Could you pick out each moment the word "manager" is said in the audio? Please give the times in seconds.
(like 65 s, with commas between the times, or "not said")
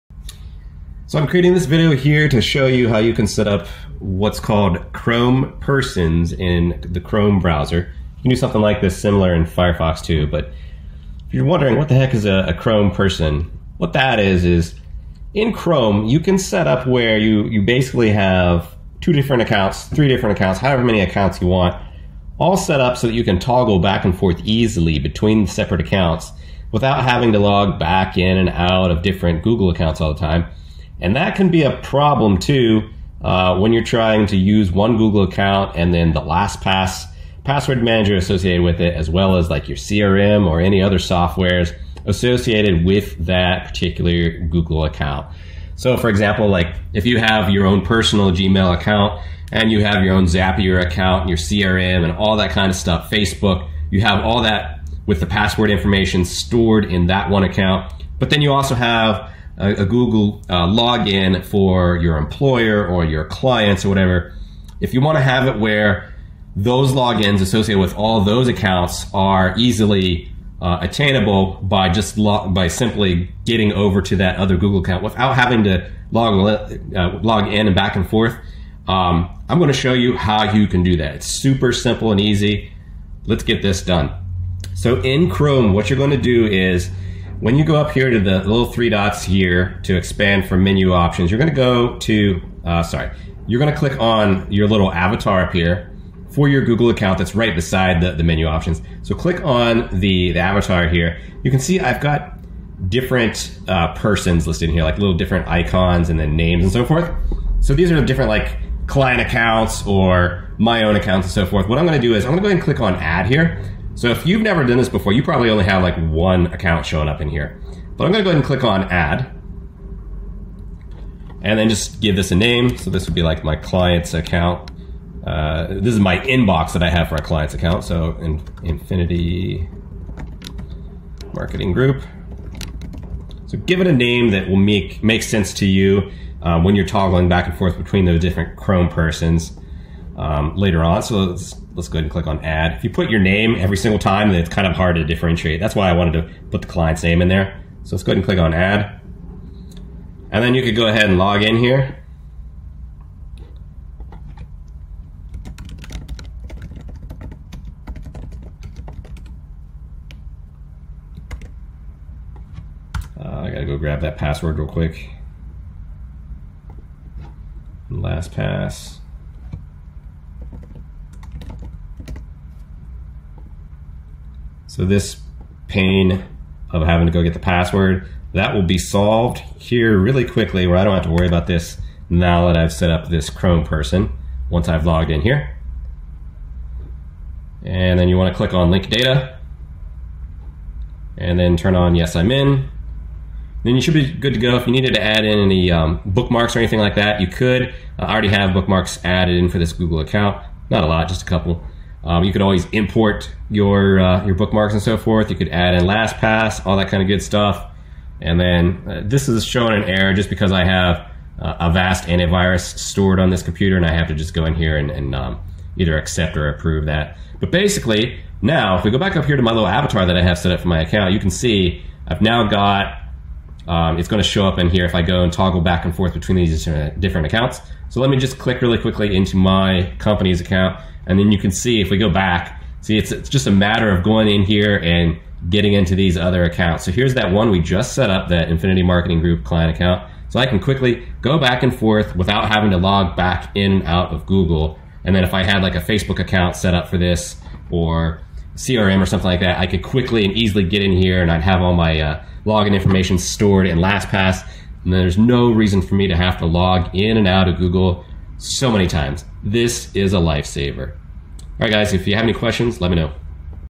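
37 s.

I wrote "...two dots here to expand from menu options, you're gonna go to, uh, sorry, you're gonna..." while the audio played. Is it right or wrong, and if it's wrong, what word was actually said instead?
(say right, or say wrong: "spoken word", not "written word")
wrong: "three", not "two".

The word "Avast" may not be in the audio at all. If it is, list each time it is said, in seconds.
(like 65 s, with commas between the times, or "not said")
211 s.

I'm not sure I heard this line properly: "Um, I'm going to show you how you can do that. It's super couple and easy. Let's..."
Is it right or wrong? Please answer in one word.
wrong.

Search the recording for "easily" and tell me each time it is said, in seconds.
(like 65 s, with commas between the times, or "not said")
24 s, 69 s, 250 s.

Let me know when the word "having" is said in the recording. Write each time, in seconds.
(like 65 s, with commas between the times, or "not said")
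27 s, 75 s, 176 s, 242 s.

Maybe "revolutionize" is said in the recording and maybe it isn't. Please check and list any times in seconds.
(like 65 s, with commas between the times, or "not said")
not said.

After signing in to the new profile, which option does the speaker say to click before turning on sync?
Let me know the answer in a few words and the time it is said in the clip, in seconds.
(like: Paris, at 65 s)
link data, at 188 s.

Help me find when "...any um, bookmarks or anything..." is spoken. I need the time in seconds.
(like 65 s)
195 s.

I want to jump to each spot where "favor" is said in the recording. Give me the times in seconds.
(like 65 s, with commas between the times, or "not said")
not said.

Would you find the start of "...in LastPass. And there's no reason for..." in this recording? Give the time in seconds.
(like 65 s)
253 s.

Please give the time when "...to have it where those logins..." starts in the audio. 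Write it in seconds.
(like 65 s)
65 s.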